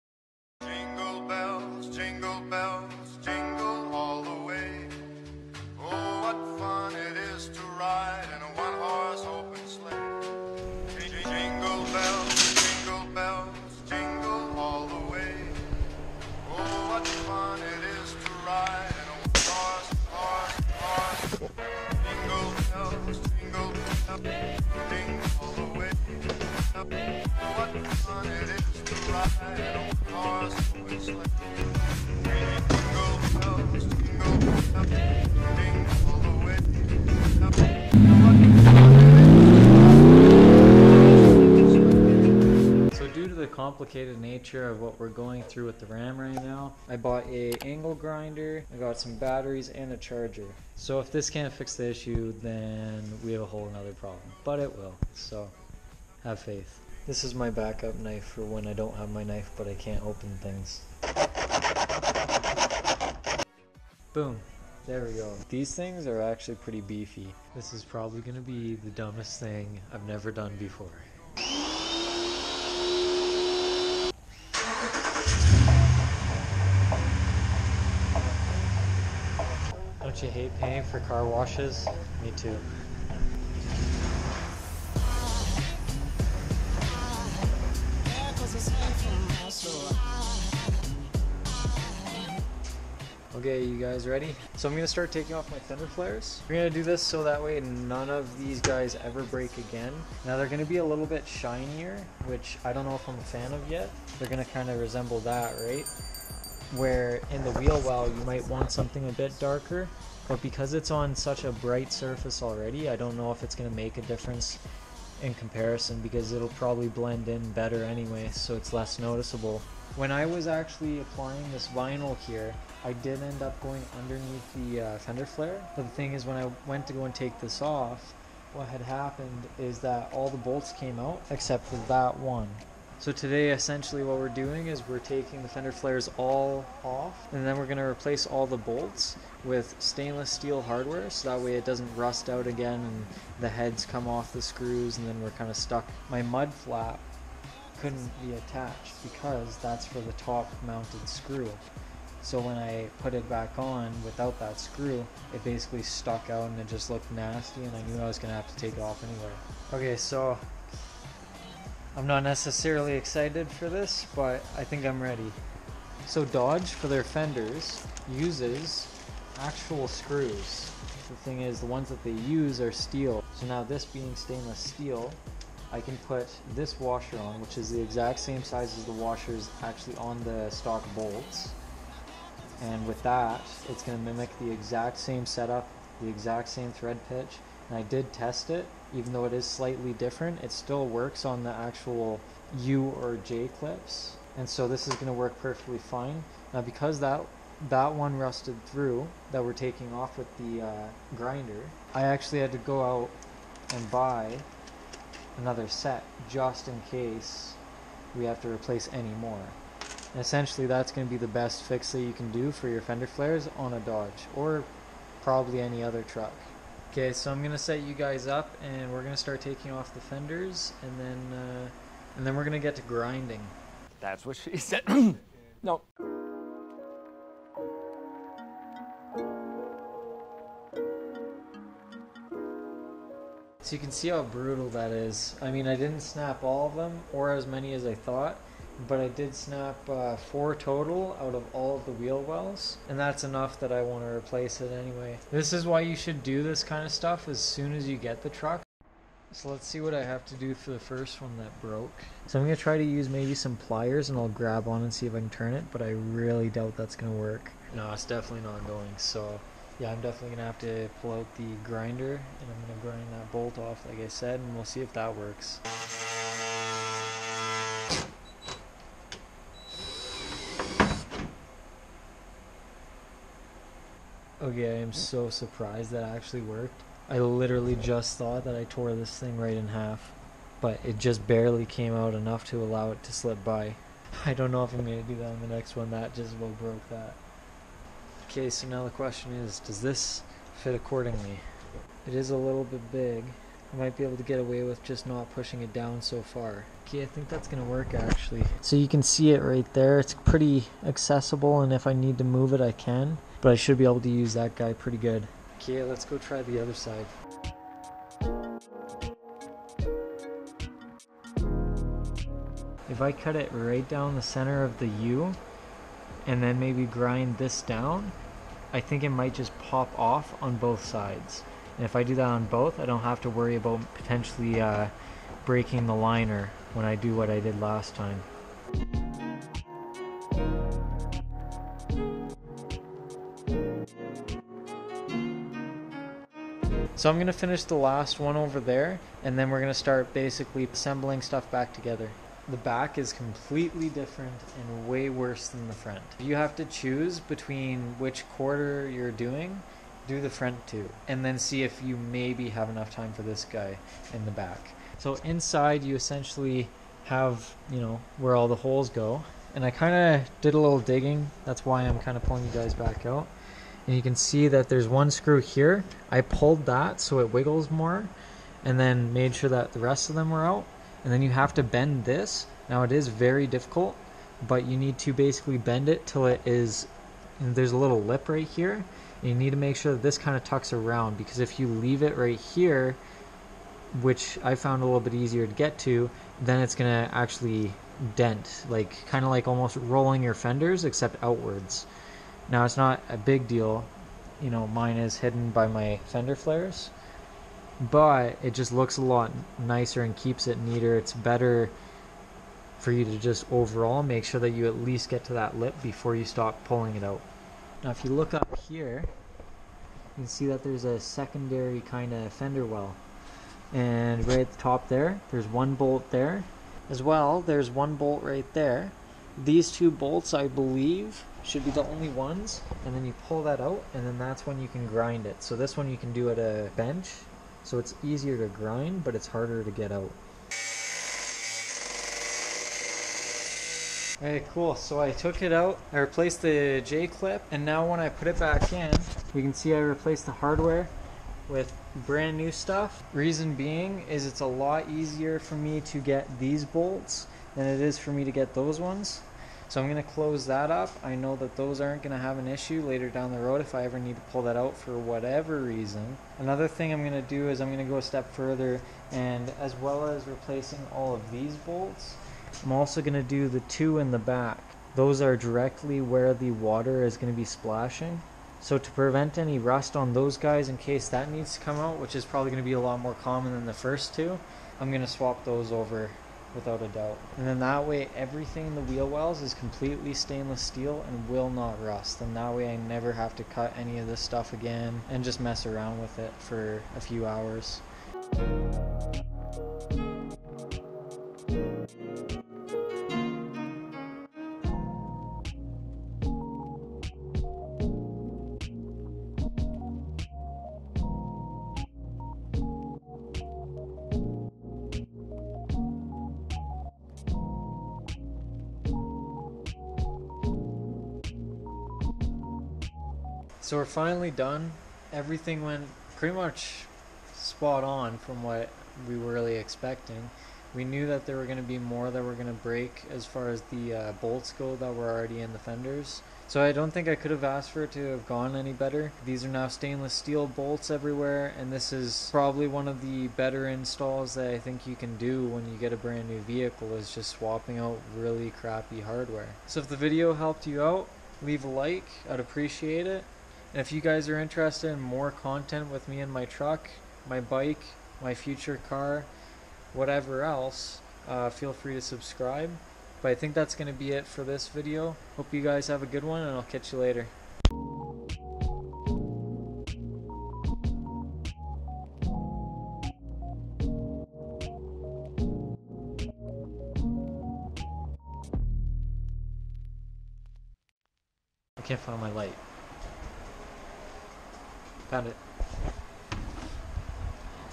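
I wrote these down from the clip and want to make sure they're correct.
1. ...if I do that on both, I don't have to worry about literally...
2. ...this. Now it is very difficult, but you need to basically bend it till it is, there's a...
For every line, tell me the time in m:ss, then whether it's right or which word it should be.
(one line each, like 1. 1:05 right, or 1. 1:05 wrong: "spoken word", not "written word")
1. 5:21 wrong: "potentially", not "literally"
2. 6:12 right.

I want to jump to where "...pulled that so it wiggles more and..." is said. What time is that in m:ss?
6:06.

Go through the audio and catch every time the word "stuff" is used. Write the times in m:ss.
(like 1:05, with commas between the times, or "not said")
4:06, 5:41, 7:22, 8:04.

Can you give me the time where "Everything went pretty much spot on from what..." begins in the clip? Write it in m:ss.
8:35.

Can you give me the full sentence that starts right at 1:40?
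Now they're gonna be a little bit shinier, which I don't know if I'm a fan of yet.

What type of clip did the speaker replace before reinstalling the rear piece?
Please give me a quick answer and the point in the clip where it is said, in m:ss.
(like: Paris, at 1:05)
J-clip, at 7:16.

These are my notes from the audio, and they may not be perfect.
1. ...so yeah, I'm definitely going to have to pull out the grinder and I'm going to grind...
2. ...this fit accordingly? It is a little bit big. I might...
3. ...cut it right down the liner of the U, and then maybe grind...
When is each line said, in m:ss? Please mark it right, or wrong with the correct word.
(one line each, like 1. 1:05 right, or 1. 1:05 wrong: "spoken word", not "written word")
1. 4:18 right
2. 4:49 right
3. 5:13 wrong: "center", not "liner".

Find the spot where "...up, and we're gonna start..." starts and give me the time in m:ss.
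3:38.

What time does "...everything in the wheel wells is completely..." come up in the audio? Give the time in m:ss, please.
7:58.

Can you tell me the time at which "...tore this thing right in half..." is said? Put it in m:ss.
4:38.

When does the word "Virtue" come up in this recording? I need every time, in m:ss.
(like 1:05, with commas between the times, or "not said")
not said.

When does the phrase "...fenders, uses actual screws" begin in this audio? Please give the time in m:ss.
2:47.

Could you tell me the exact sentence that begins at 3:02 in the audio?
And with that, it's gonna mimic the exact same setup, the exact same thread pitch.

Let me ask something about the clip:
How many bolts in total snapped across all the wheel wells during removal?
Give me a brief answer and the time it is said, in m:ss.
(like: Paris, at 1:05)
4, at 4:00.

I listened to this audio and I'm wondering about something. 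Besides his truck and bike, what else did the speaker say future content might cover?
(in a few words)
future car.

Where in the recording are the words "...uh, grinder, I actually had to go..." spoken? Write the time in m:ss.
3:20.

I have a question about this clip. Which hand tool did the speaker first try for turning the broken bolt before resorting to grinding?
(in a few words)
pliers.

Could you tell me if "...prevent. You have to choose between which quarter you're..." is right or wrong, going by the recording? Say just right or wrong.
wrong.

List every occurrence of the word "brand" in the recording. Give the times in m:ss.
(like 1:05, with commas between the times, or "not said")
7:22, 8:55.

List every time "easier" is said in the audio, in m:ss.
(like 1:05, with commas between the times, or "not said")
6:25, 7:08, 7:24.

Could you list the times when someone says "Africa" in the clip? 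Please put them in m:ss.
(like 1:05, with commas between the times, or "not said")
not said.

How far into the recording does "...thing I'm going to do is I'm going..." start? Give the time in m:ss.
7:36.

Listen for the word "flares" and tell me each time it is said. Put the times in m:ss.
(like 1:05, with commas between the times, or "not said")
1:35, 2:05, 2:15, 3:33, 6:36.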